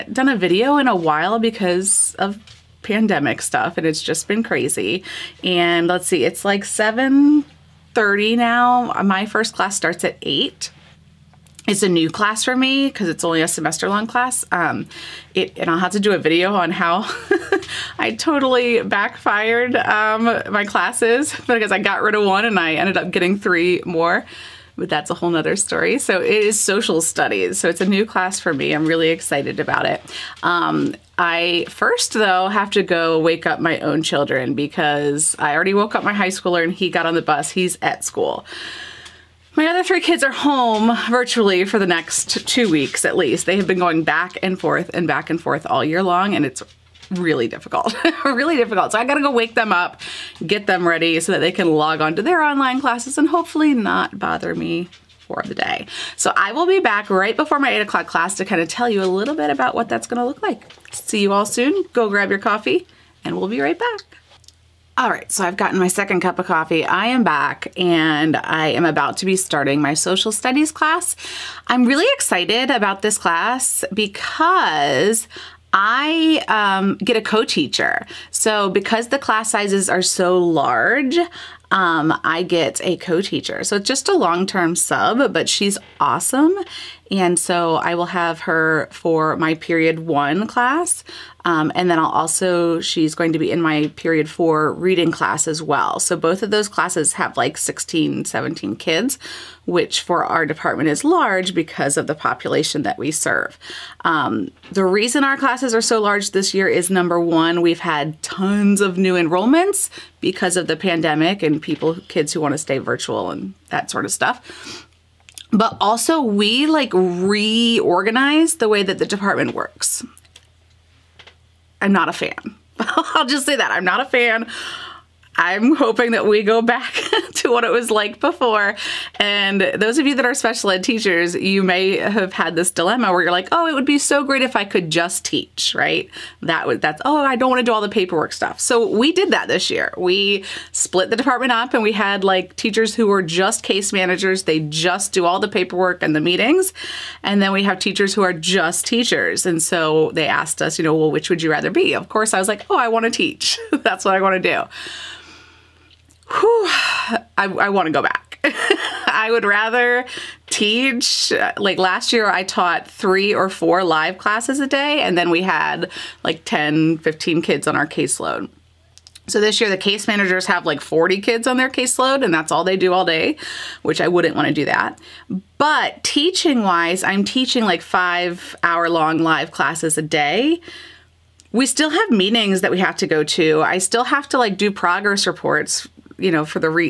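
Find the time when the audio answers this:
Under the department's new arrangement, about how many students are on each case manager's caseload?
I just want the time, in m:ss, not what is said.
2:50.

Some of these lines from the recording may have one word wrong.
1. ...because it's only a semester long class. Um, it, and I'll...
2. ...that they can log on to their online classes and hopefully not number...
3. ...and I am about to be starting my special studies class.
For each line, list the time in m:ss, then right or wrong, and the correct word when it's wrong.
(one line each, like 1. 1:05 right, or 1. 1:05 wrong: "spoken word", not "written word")
1. 0:12 right
2. 0:51 wrong: "bother", not "number"
3. 1:07 wrong: "social", not "special".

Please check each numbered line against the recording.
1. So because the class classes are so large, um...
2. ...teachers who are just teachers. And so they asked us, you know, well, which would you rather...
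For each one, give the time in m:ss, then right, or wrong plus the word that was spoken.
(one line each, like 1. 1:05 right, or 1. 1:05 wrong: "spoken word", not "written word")
1. 1:18 wrong: "sizes", not "classes"
2. 2:27 right.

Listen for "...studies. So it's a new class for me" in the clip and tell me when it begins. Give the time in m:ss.
0:27.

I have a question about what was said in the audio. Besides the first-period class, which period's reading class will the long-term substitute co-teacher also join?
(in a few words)
period 4.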